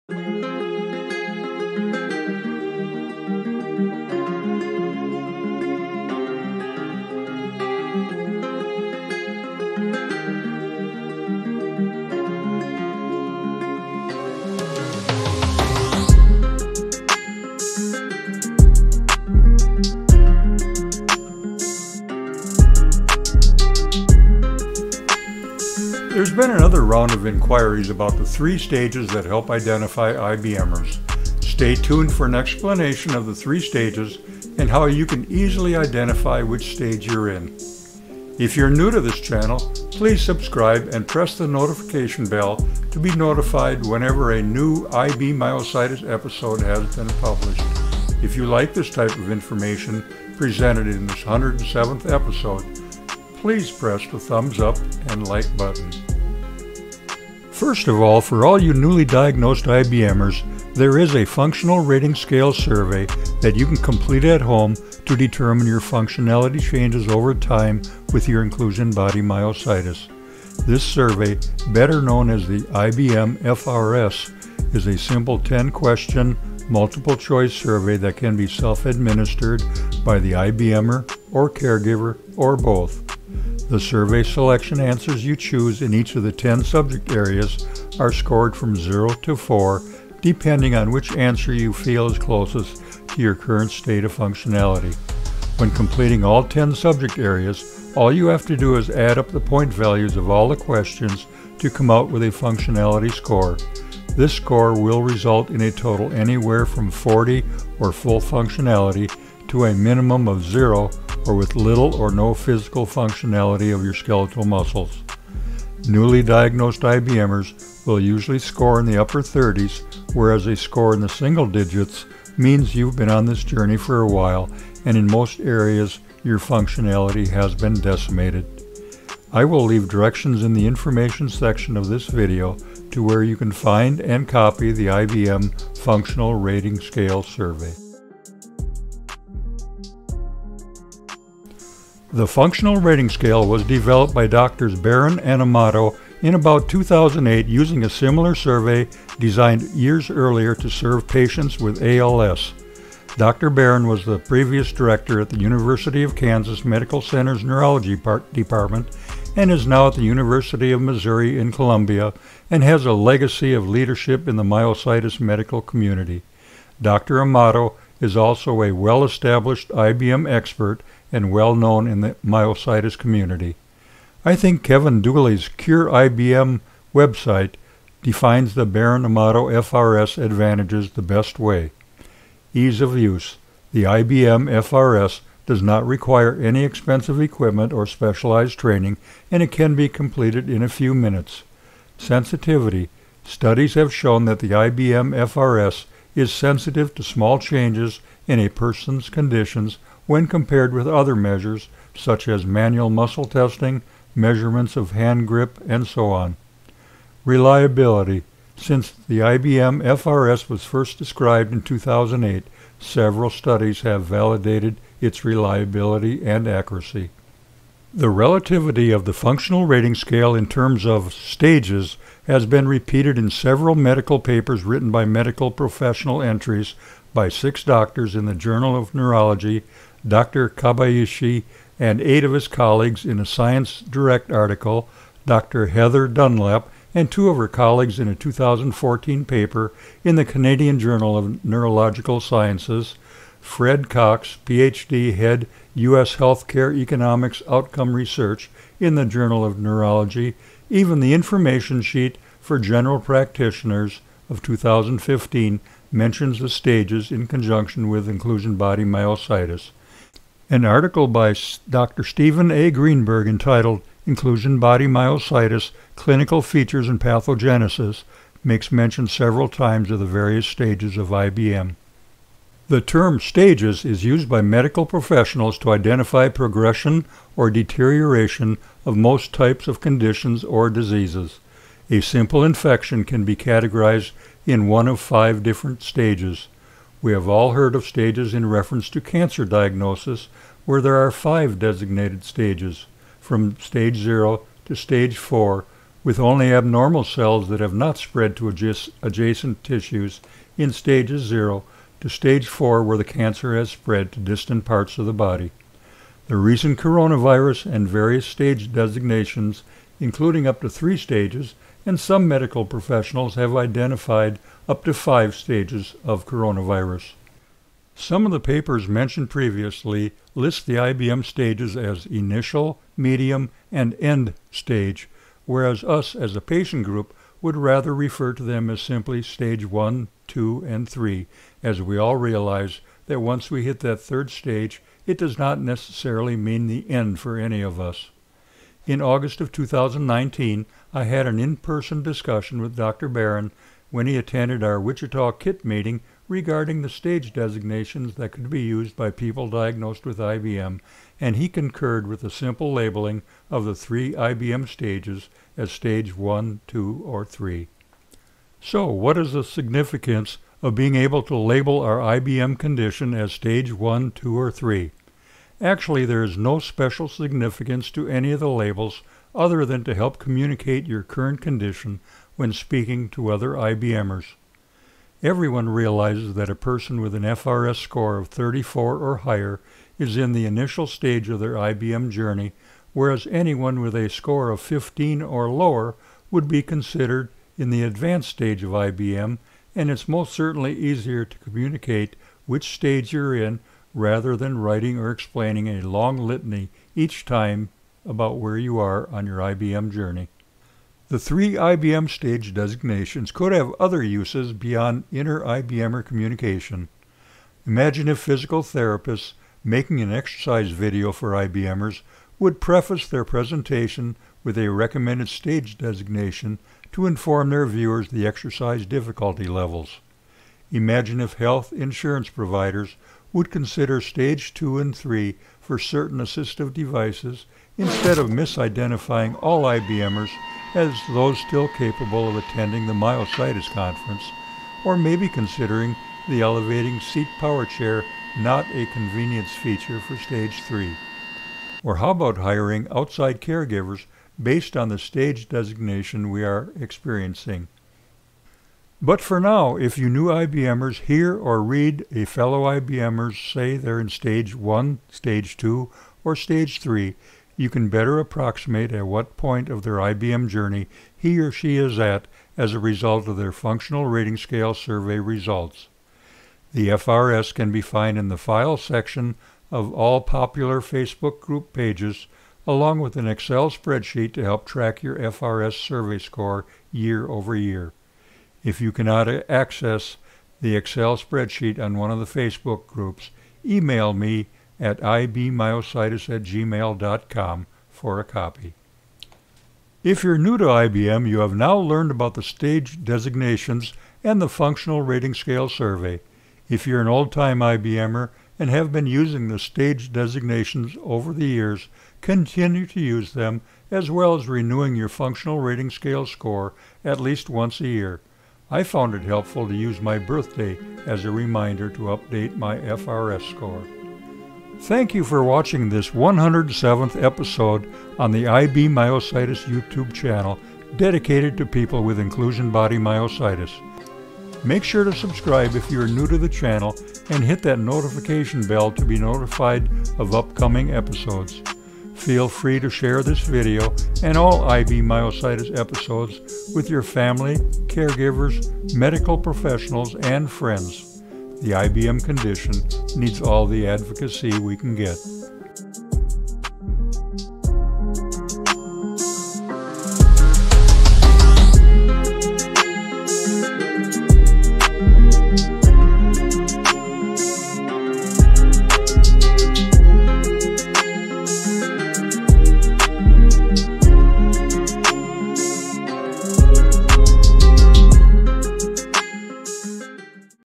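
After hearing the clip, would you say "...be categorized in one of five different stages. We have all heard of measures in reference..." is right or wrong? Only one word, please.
wrong.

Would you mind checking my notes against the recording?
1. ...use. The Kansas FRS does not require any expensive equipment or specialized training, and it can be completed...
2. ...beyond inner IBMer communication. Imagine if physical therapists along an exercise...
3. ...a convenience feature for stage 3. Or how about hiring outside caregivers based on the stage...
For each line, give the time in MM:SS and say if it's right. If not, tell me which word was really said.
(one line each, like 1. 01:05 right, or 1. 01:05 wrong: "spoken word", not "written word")
1. 03:02 wrong: "IBM", not "Kansas"
2. 06:44 wrong: "making", not "along"
3. 07:18 right.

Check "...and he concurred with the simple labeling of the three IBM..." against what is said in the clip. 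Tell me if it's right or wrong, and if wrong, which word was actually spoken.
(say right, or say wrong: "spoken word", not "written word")
right.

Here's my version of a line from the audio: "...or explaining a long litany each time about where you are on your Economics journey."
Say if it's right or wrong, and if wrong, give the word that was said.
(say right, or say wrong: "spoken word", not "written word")
wrong: "IBM", not "Economics".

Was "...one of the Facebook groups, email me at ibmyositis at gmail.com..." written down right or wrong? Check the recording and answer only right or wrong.
right.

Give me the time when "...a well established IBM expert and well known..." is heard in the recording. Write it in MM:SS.
02:48.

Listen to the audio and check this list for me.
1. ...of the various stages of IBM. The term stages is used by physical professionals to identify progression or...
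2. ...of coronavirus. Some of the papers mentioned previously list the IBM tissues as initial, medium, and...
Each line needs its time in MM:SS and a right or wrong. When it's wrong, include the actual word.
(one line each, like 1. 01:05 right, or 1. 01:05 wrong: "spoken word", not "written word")
1. 04:29 wrong: "medical", not "physical"
2. 05:16 wrong: "stages", not "tissues".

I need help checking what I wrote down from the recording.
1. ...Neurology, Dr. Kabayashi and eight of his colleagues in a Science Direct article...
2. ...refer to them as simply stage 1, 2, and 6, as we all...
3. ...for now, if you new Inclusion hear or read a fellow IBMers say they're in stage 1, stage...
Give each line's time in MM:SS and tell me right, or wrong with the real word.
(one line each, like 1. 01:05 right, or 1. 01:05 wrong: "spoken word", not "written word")
1. 03:48 right
2. 05:27 wrong: "3", not "6"
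3. 07:29 wrong: "IBMers", not "Inclusion".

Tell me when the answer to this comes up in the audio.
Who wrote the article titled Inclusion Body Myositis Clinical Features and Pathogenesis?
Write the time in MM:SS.
04:22.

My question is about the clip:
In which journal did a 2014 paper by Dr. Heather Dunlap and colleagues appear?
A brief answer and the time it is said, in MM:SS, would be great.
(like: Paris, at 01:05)
Canadian Journal of Neurological Sciences, at 04:00.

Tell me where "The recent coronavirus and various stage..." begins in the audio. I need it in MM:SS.
05:06.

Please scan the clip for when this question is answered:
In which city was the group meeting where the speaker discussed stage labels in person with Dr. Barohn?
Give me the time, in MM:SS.
05:44.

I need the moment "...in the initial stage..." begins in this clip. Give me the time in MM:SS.
06:20.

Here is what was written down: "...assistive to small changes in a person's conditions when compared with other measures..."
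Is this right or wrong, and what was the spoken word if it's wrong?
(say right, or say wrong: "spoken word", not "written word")
wrong: "sensitive", not "assistive".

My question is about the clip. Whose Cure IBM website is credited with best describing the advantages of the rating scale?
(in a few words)
Kevin Dooley.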